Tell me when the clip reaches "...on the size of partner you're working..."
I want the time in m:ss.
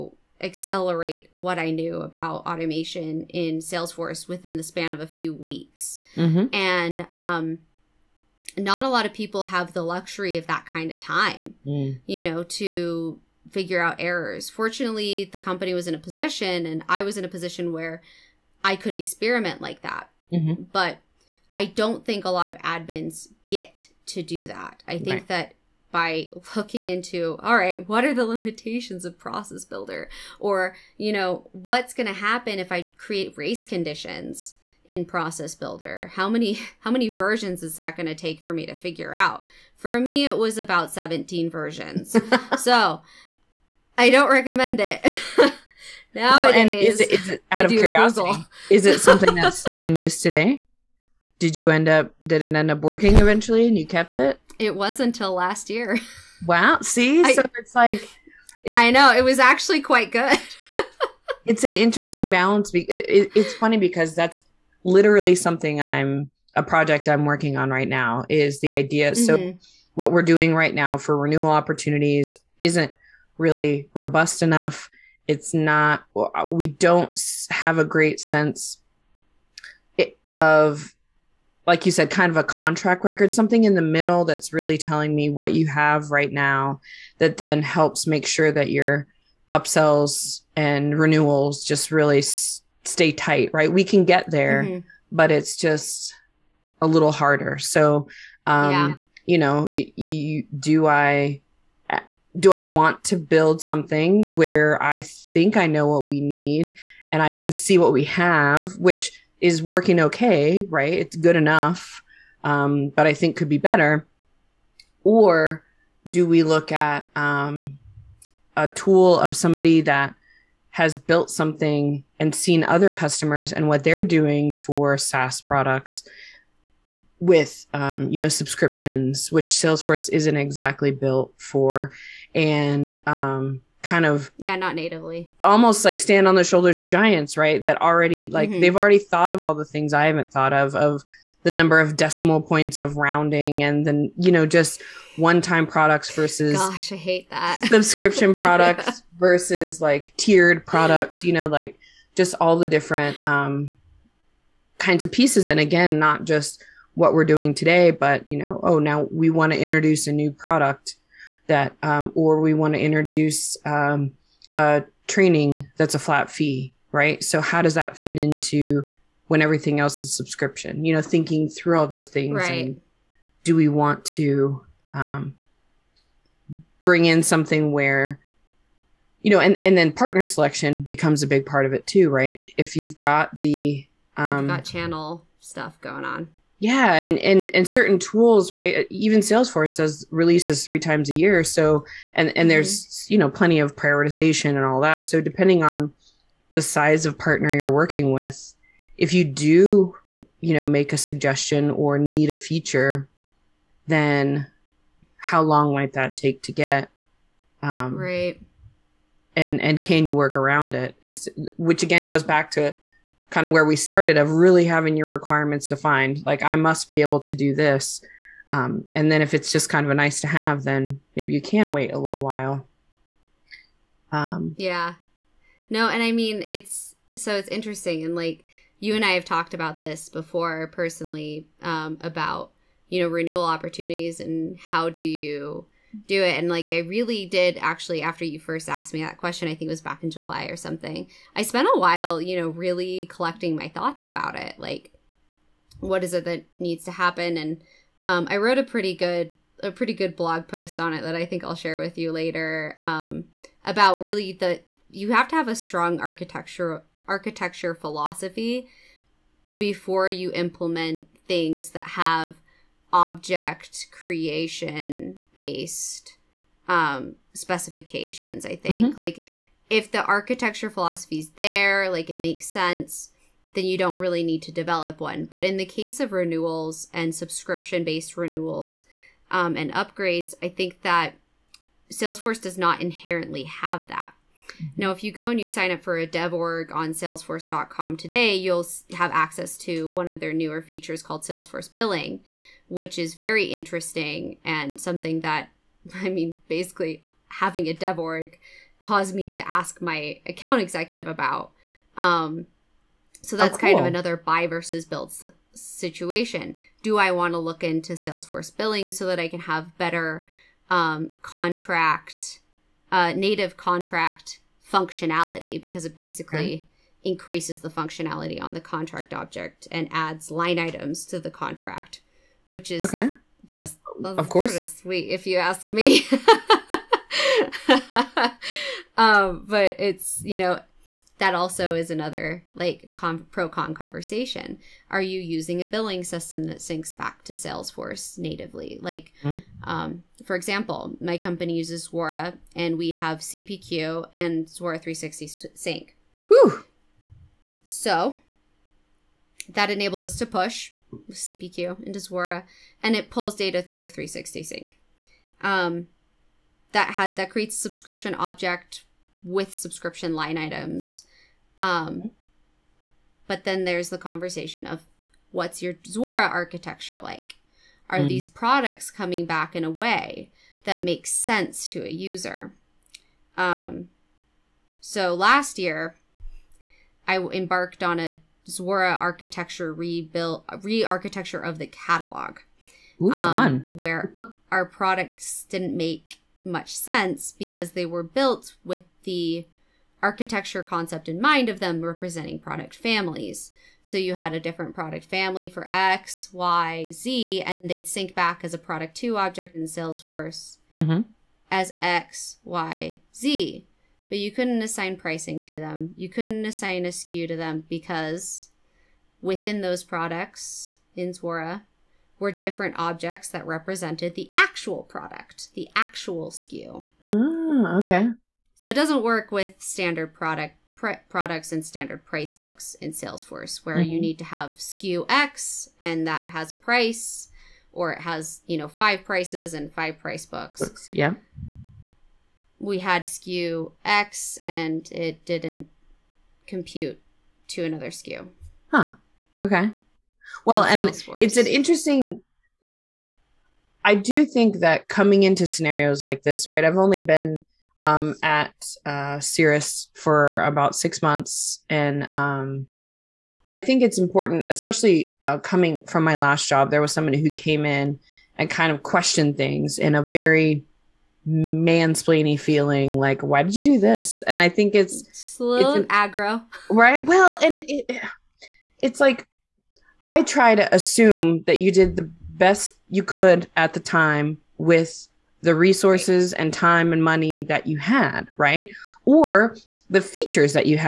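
3:15.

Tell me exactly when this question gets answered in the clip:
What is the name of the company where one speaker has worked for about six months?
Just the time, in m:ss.
7:29.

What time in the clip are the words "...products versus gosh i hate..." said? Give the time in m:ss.
2:25.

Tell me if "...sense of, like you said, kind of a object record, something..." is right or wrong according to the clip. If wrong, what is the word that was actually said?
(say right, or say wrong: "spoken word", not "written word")
wrong: "contract", not "object".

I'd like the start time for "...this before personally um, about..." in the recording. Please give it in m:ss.
3:49.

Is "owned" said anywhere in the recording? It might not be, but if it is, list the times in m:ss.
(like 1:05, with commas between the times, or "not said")
not said.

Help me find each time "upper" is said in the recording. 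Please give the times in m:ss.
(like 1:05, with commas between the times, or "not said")
not said.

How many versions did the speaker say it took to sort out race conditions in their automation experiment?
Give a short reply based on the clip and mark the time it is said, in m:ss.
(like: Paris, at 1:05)
17, at 0:40.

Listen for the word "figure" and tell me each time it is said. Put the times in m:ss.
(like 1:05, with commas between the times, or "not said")
0:13, 0:38.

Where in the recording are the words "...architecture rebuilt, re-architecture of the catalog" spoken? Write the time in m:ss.
6:18.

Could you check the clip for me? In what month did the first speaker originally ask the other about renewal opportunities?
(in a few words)
July.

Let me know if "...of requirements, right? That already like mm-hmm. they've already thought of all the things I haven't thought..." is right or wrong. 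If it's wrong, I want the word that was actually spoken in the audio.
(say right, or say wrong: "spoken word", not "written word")
wrong: "giants", not "requirements".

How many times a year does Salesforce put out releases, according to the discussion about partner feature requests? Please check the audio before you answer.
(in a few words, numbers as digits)
3.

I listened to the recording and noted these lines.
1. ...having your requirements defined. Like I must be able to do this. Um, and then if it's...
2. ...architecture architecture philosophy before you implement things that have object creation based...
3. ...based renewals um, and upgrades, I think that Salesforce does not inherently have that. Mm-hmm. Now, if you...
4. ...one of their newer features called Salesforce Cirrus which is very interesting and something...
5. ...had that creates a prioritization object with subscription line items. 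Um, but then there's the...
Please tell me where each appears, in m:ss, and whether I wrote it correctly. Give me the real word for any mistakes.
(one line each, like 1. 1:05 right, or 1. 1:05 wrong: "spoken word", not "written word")
1. 3:34 right
2. 4:15 right
3. 4:37 right
4. 4:49 wrong: "Billing", not "Cirrus"
5. 5:56 wrong: "subscription", not "prioritization".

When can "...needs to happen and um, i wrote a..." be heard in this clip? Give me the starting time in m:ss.
4:06.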